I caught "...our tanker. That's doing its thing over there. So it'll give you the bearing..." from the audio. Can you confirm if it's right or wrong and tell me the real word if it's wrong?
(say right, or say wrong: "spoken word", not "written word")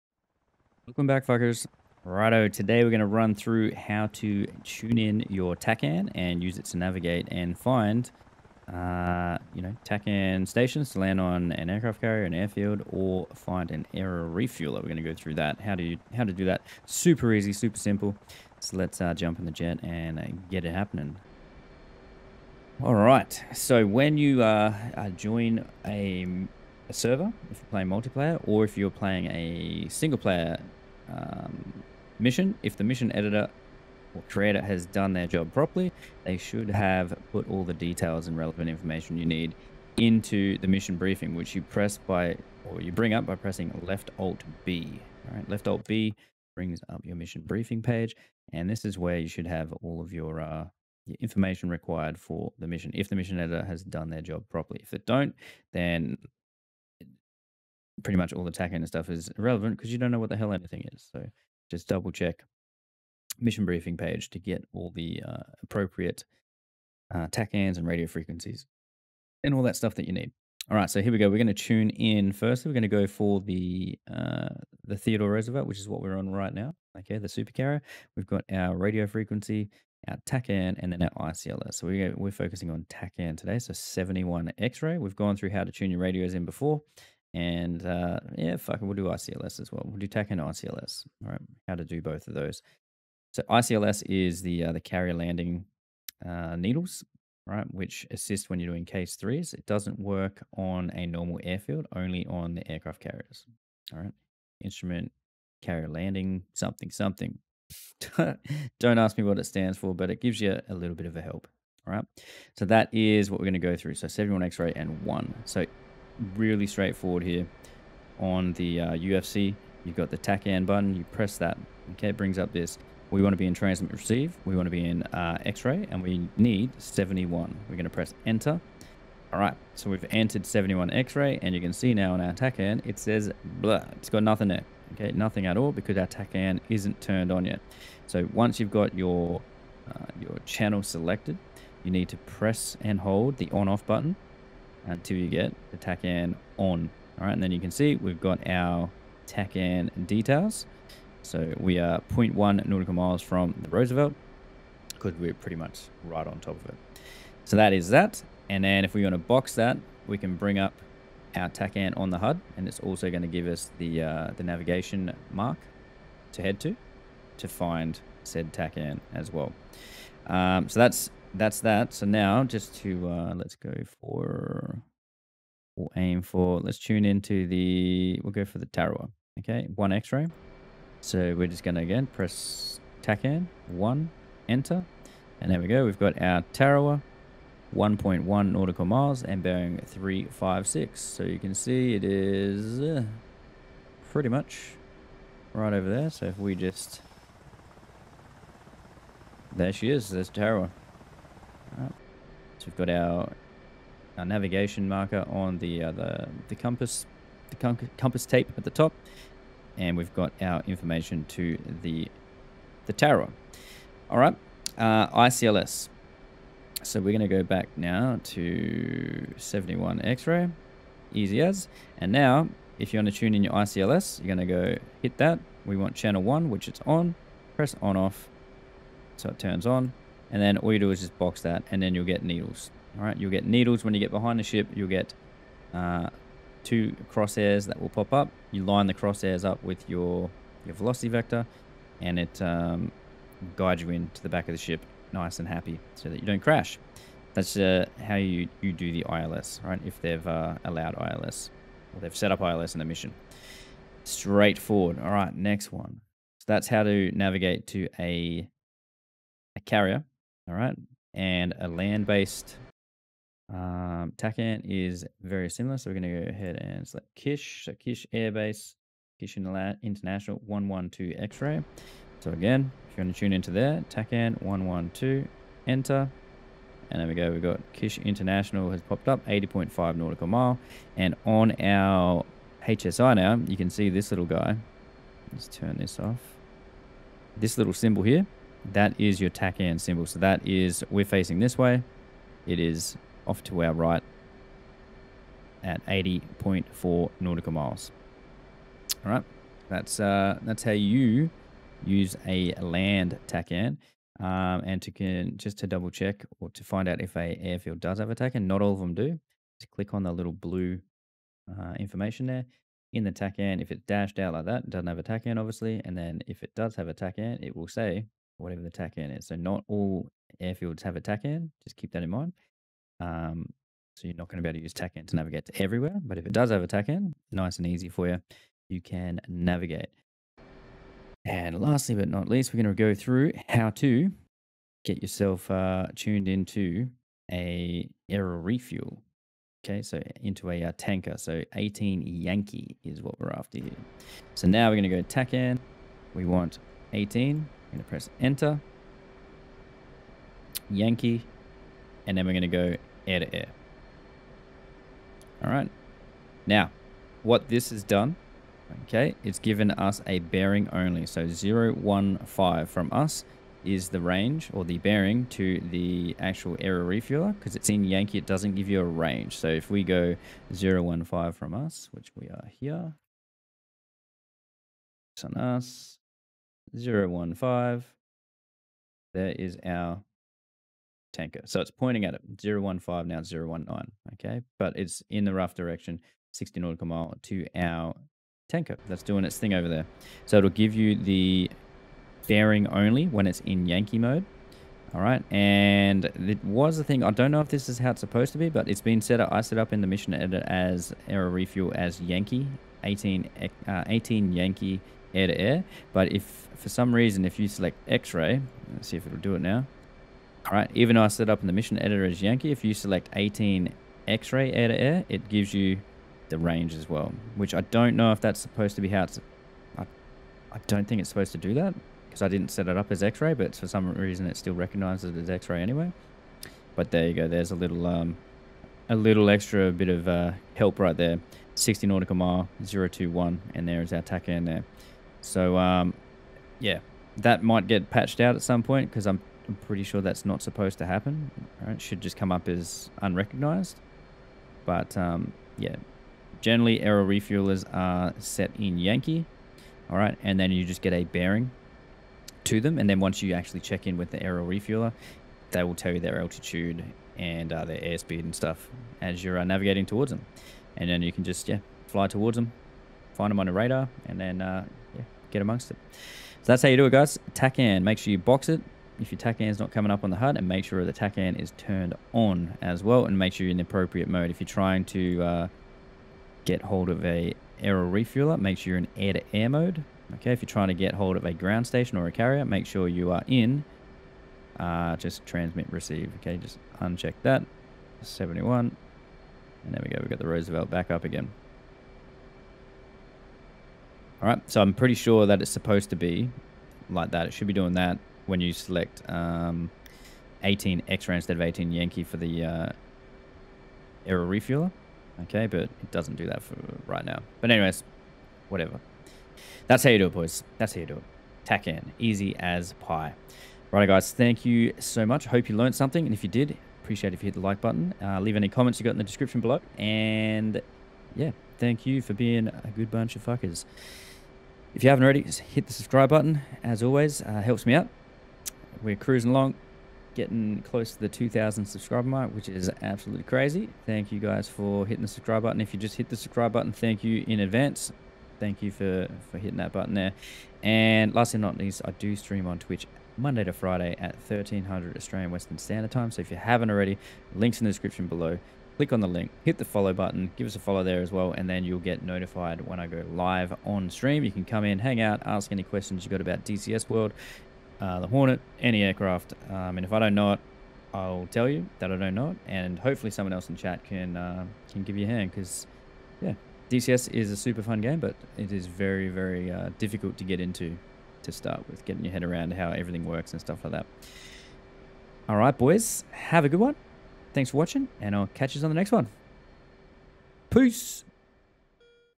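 right.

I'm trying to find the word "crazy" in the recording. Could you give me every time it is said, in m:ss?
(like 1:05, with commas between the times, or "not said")
8:53.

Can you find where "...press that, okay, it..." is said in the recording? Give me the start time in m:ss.
2:01.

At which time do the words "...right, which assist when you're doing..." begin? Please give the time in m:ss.
1:37.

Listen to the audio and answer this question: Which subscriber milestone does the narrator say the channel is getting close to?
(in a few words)
2,000.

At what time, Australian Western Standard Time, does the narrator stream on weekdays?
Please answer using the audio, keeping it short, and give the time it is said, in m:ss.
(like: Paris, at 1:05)
1300, at 9:04.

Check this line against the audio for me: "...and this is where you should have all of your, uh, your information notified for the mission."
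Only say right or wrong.
wrong.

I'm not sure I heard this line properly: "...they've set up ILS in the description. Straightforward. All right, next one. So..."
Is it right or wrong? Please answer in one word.
wrong.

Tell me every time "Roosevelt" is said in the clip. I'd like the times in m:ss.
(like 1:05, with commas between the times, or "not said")
1:15, 2:33, 8:10.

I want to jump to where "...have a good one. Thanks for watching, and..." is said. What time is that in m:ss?
9:36.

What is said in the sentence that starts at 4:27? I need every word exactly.
So Kish Airbase, Kish International 112 X ray.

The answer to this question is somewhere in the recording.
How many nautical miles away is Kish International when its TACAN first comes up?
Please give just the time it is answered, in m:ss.
4:39.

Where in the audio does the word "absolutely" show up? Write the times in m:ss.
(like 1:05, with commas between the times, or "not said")
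8:52.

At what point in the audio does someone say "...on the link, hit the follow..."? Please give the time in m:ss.
9:08.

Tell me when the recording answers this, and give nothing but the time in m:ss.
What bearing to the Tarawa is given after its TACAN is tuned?
3:09.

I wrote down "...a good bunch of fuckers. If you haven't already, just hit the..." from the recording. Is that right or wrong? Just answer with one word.
right.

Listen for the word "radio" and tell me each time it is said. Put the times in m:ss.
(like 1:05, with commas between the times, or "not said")
1:07, 1:18, 1:25.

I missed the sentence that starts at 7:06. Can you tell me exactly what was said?
But there you go, there's a little, um, a little extra bit of uh, help right there.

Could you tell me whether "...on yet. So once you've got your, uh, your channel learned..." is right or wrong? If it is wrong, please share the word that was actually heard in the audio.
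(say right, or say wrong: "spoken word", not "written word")
wrong: "selected", not "learned".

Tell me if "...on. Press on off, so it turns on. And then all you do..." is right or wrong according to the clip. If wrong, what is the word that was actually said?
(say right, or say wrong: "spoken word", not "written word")
right.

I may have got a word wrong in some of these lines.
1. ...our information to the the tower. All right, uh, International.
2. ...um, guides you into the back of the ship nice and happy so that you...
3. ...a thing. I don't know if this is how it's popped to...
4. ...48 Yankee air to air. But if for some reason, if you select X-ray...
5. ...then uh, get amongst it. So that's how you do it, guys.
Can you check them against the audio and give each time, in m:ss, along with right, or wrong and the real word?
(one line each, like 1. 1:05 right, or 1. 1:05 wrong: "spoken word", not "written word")
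1. 3:30 wrong: "ICLS", not "International"
2. 4:02 right
3. 6:36 wrong: "supposed", not "popped"
4. 6:43 wrong: "18", not "48"
5. 7:44 right.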